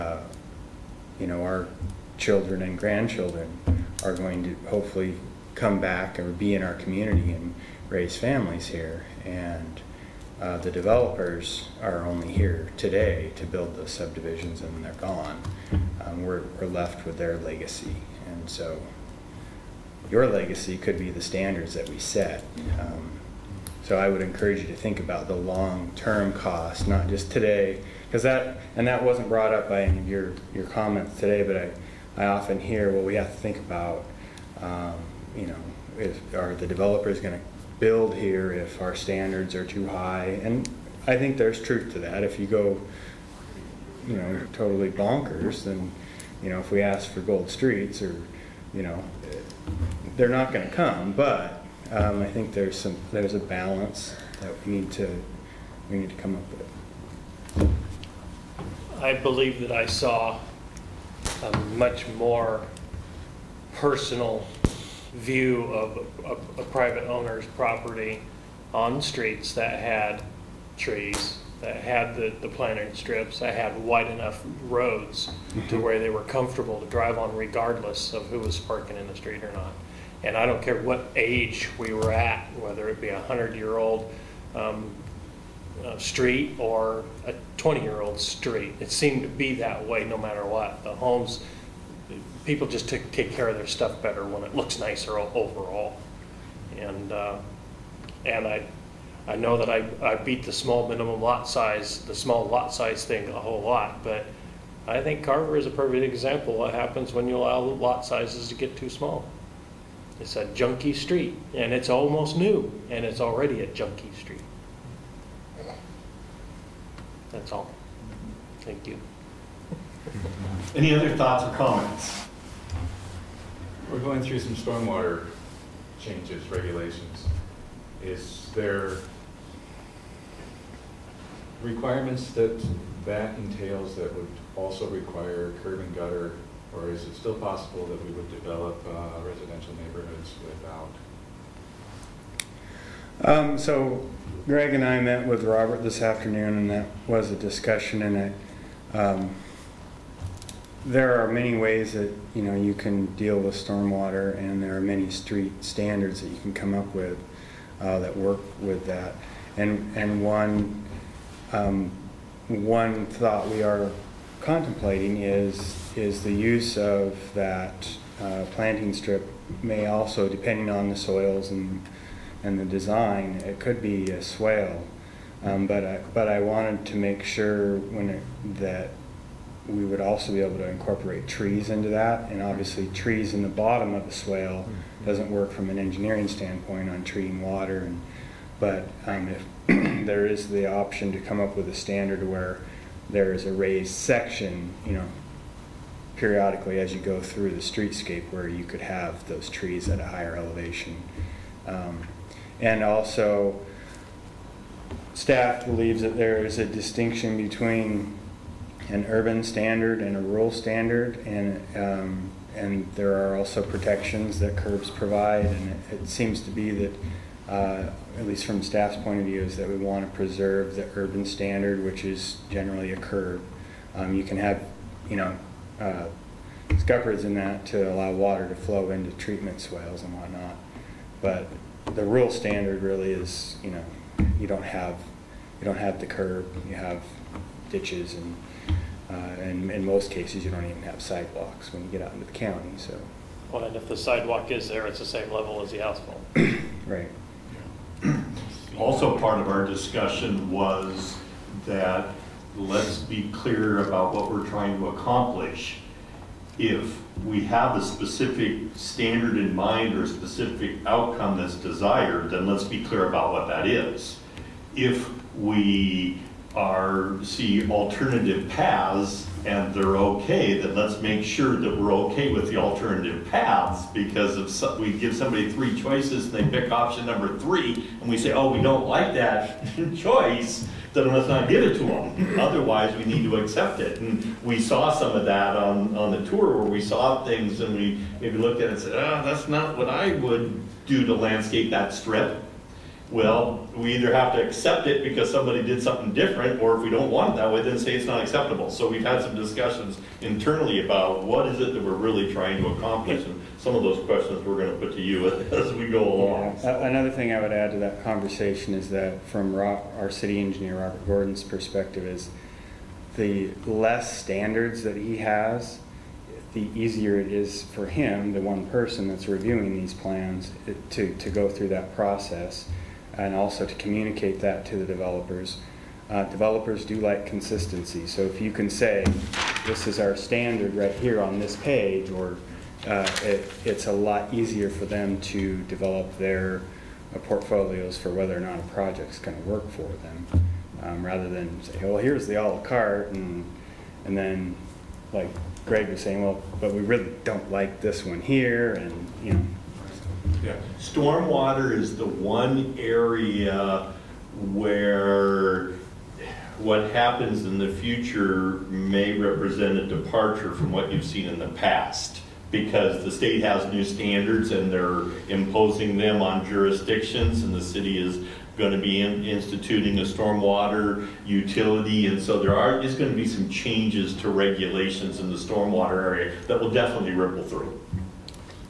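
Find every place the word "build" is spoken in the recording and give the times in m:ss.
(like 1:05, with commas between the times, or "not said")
0:13, 0:37.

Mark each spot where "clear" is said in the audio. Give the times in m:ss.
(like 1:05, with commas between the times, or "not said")
4:13, 4:22.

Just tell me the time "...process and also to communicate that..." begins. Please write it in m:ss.
5:21.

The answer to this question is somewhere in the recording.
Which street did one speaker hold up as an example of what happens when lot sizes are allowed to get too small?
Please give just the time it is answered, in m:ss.
1:45.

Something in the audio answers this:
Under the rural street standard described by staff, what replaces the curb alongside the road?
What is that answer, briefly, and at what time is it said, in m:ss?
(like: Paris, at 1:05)
ditches, at 3:57.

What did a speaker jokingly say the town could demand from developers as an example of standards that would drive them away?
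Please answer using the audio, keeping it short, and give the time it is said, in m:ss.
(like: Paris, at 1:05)
gold streets, at 0:47.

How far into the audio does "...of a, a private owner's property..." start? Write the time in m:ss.
1:05.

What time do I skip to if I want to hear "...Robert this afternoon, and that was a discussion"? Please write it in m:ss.
2:25.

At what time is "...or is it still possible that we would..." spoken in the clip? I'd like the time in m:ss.
2:16.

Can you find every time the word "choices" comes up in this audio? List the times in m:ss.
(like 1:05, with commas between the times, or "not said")
4:35, 4:39.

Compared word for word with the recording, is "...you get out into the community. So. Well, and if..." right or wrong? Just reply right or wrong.
wrong.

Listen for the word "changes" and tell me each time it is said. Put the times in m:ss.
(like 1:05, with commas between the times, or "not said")
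2:05, 6:13.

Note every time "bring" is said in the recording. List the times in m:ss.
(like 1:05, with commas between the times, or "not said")
not said.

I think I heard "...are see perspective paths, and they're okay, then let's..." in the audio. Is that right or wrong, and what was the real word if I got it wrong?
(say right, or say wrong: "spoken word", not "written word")
wrong: "alternative", not "perspective".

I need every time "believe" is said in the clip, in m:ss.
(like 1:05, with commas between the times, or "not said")
0:59, 3:25.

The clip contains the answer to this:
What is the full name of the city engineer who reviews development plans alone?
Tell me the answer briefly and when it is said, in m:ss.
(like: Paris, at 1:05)
Robert Gordon, at 5:10.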